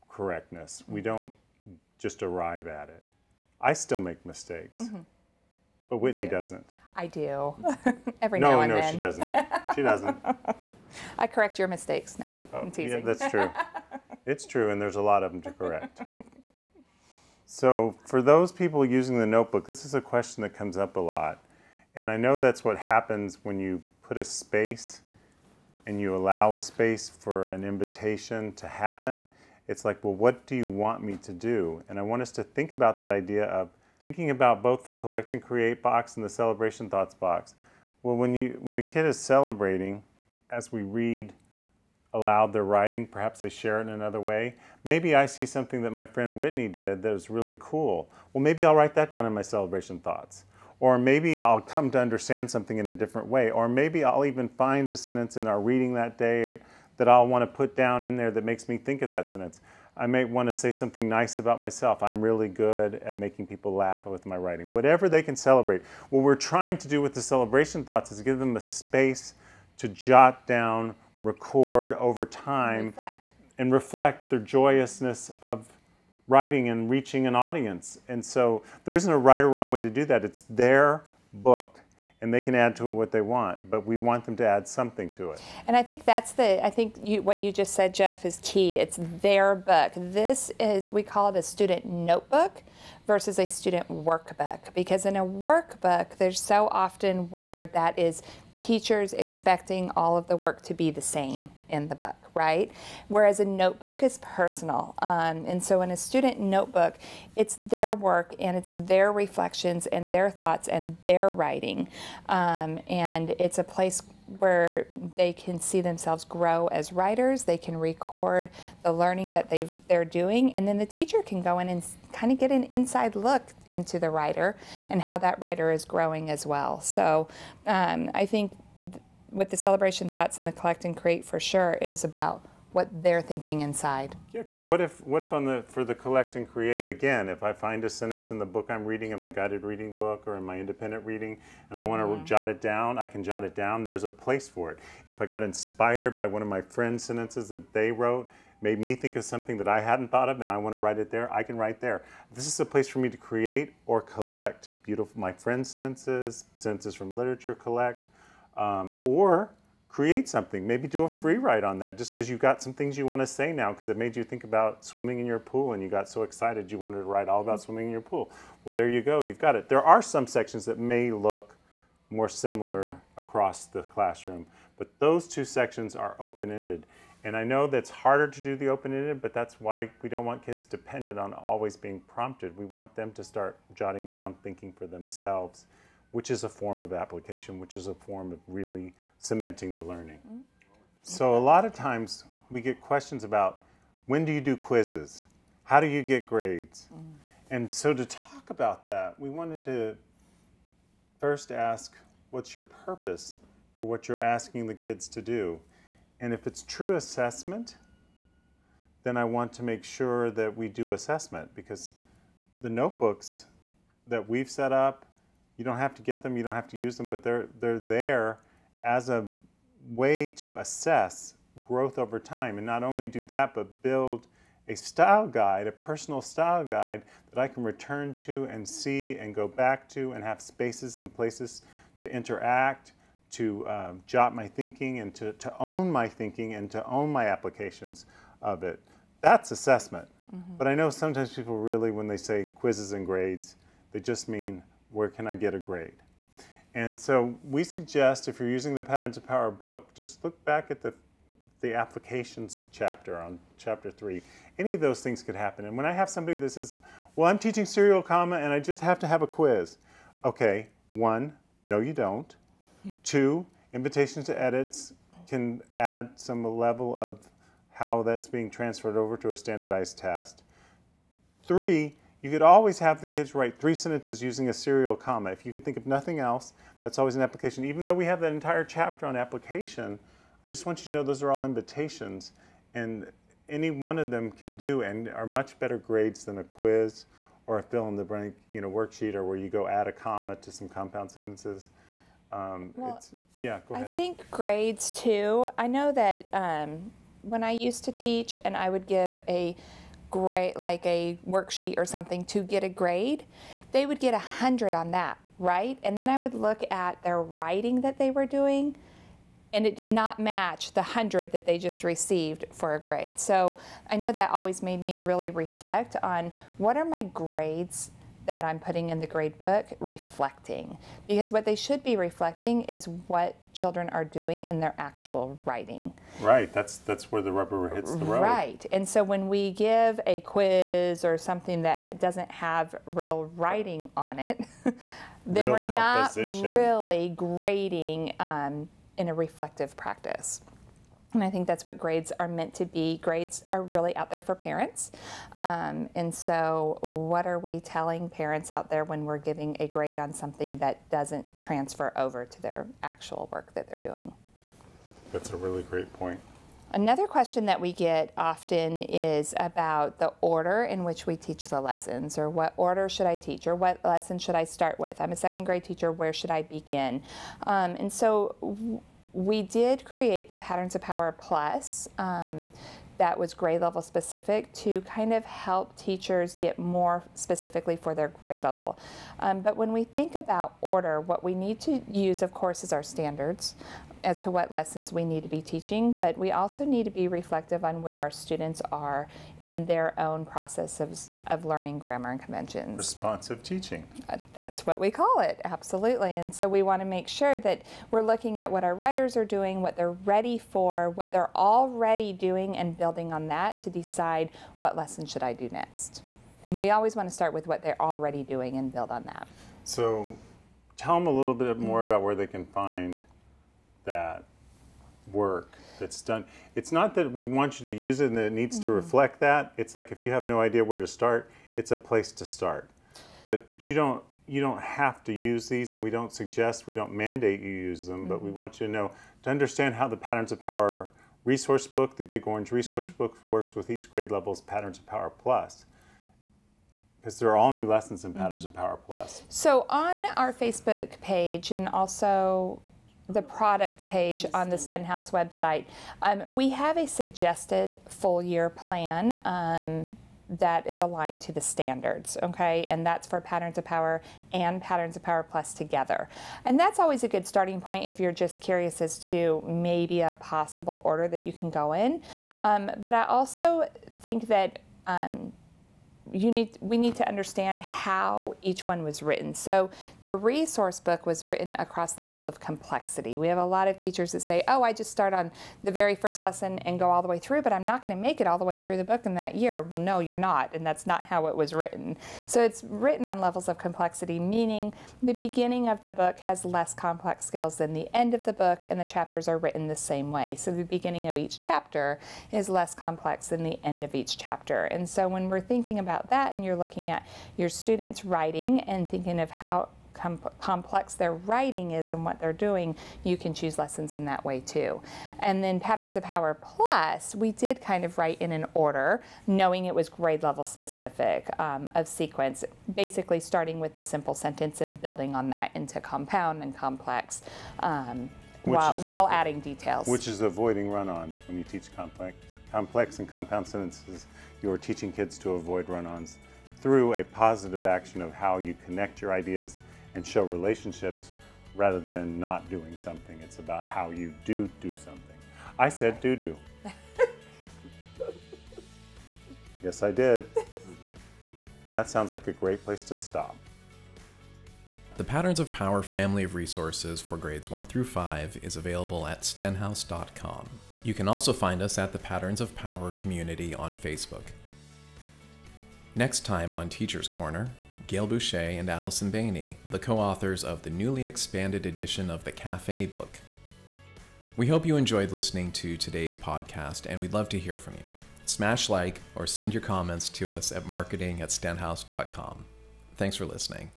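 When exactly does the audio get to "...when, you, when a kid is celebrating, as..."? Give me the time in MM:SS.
00:38.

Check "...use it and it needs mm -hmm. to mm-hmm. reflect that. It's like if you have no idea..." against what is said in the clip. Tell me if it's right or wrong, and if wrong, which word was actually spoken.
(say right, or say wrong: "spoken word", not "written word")
right.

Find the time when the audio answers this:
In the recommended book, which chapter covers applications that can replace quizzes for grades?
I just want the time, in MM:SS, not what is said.
04:13.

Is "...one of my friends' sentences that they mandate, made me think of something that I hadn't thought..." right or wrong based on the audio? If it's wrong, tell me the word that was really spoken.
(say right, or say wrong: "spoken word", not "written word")
wrong: "wrote", not "mandate".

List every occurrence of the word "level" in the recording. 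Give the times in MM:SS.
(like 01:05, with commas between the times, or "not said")
04:26, 06:13, 06:18, 07:14, 07:51, 08:03, 08:30.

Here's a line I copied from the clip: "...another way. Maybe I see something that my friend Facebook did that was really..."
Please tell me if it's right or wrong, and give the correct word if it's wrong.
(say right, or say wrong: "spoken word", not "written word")
wrong: "Whitney", not "Facebook".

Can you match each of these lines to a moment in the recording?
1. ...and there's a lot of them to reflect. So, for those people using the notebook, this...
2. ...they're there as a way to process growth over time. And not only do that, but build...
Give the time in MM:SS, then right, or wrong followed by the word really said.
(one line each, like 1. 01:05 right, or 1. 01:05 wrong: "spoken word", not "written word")
1. 00:14 wrong: "correct", not "reflect"
2. 03:37 wrong: "assess", not "process".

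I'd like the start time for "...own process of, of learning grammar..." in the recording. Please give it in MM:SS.
06:29.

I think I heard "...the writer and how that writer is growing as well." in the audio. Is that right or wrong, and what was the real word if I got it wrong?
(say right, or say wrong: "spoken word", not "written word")
right.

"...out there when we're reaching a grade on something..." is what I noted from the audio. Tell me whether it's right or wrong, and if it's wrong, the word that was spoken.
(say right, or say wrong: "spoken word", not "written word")
wrong: "giving", not "reaching".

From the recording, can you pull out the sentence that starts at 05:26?
Right, that's that's where the rubber hits the road.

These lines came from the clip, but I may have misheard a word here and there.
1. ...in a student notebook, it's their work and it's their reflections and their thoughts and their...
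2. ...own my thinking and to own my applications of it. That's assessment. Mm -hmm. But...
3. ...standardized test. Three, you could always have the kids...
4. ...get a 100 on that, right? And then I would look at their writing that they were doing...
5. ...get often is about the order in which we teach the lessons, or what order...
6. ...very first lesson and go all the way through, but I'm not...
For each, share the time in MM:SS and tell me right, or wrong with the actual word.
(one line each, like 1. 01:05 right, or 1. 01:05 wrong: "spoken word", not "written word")
1. 01:45 right
2. 03:55 right
3. 04:29 right
4. 05:03 right
5. 05:57 right
6. 07:55 right.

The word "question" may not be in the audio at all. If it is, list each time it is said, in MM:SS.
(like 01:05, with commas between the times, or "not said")
00:20, 03:12, 05:57.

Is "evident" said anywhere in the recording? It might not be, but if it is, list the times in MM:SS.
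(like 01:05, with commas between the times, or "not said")
not said.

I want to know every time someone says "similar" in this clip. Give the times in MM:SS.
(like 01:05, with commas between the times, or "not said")
02:52.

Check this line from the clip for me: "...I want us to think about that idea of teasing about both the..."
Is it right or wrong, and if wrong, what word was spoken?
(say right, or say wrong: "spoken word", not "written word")
wrong: "thinking", not "teasing".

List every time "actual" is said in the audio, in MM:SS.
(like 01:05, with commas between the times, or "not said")
05:24, 05:52.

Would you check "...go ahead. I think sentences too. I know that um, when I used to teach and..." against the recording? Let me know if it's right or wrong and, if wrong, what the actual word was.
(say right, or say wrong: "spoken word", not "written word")
wrong: "grades", not "sentences".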